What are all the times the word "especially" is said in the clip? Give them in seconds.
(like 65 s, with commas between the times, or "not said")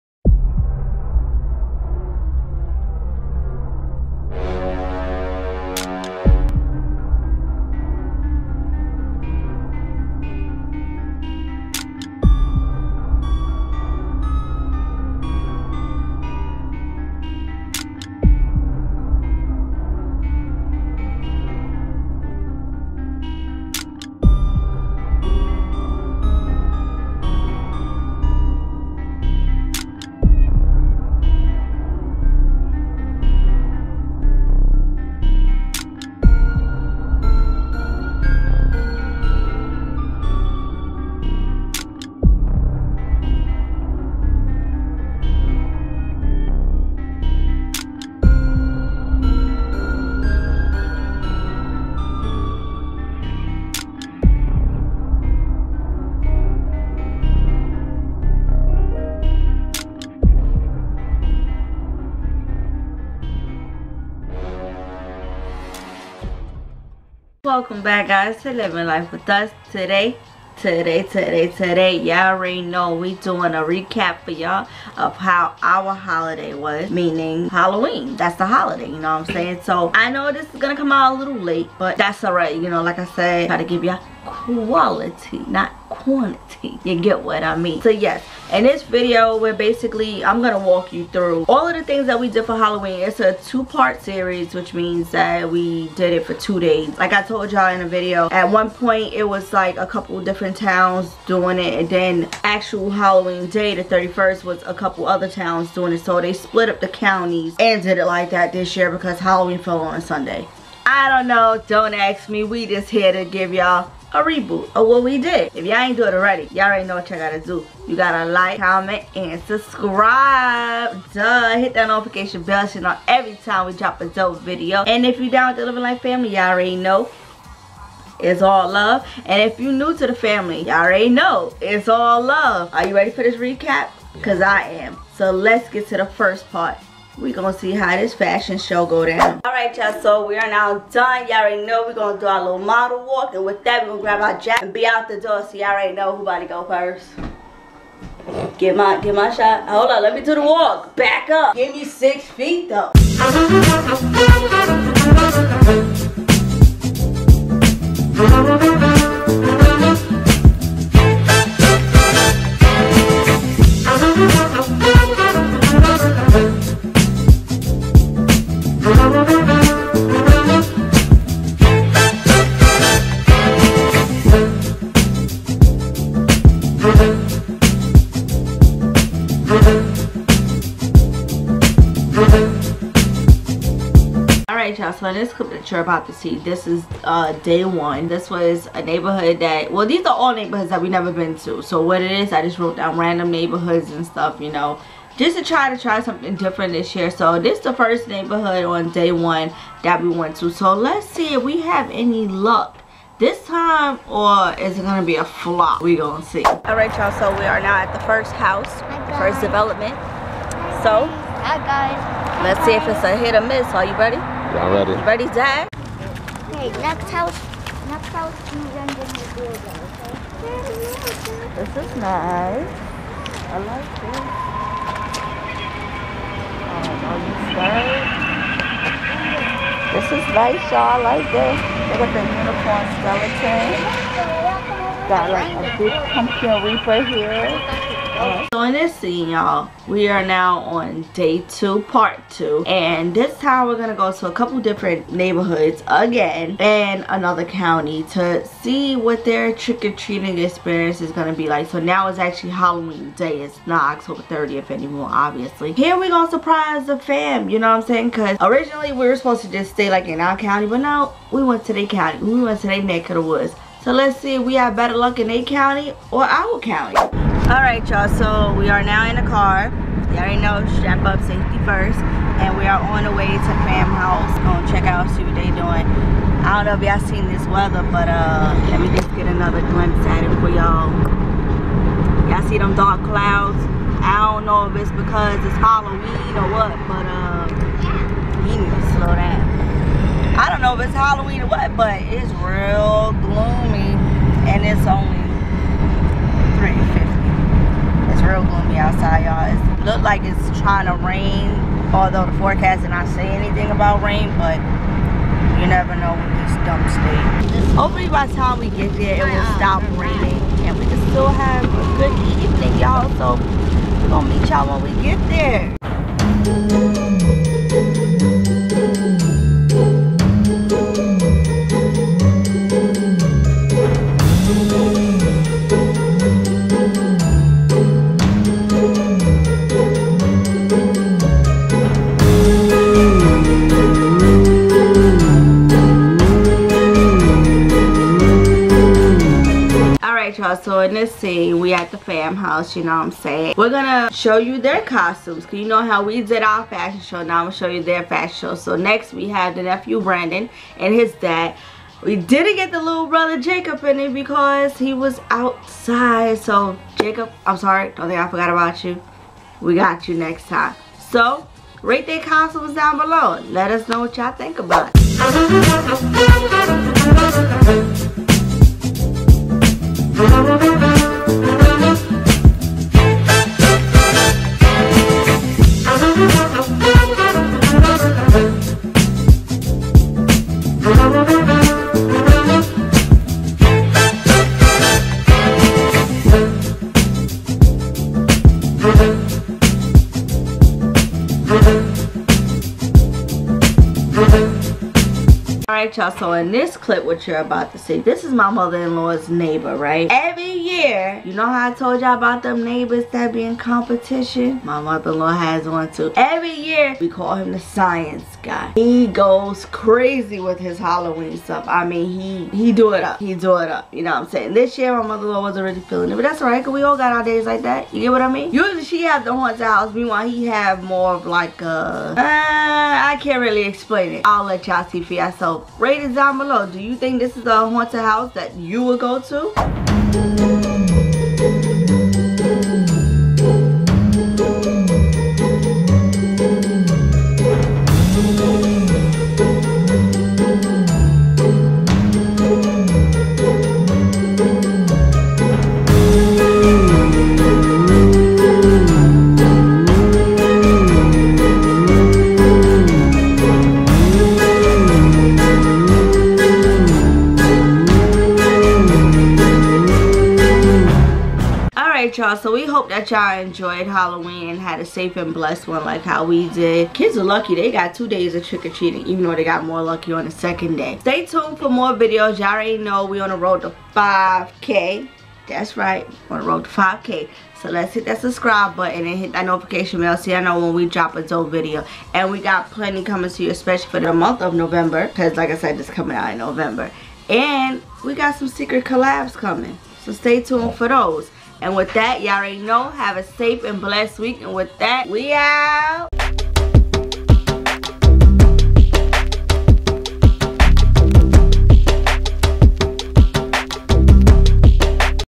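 483 s.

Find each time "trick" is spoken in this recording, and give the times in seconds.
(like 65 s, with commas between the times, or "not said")
249 s, 468 s.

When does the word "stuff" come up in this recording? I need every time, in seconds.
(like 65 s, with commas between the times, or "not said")
194 s, 411 s.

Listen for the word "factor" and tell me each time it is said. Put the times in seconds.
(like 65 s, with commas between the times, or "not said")
not said.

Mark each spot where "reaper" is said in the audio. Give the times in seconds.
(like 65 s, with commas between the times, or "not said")
236 s.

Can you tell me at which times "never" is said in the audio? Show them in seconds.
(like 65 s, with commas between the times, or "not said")
190 s, 305 s.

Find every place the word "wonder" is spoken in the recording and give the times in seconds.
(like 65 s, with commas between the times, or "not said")
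not said.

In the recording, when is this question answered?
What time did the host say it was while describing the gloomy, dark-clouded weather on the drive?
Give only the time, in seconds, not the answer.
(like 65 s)
296 s.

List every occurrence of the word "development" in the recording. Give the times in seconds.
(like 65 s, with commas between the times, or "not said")
209 s.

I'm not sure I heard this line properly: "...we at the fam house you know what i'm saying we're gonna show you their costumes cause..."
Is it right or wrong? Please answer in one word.
right.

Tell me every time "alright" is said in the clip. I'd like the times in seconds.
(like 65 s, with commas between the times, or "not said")
395 s, 416 s.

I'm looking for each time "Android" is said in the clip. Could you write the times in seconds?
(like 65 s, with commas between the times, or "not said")
not said.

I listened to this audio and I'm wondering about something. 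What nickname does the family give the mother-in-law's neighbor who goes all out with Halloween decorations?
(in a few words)
the science guy.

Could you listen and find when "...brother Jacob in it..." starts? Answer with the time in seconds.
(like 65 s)
353 s.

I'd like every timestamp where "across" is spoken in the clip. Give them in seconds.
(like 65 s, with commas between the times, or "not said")
not said.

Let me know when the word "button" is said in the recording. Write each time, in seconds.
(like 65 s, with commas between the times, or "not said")
478 s.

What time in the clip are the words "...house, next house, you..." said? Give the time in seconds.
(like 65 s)
217 s.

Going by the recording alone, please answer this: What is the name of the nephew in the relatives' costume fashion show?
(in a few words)
Brandon.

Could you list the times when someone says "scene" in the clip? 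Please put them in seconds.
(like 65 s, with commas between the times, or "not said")
238 s, 341 s.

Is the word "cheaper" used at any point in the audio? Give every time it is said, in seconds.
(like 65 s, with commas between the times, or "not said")
not said.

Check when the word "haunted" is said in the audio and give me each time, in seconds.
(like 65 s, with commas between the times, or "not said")
419 s, 427 s.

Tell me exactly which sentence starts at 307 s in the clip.
Hopefully by the time we get there, it will stop raining and we can still have a good evening, y'all.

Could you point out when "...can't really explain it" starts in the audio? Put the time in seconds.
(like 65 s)
423 s.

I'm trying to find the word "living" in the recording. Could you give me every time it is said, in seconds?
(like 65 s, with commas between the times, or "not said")
68 s, 125 s.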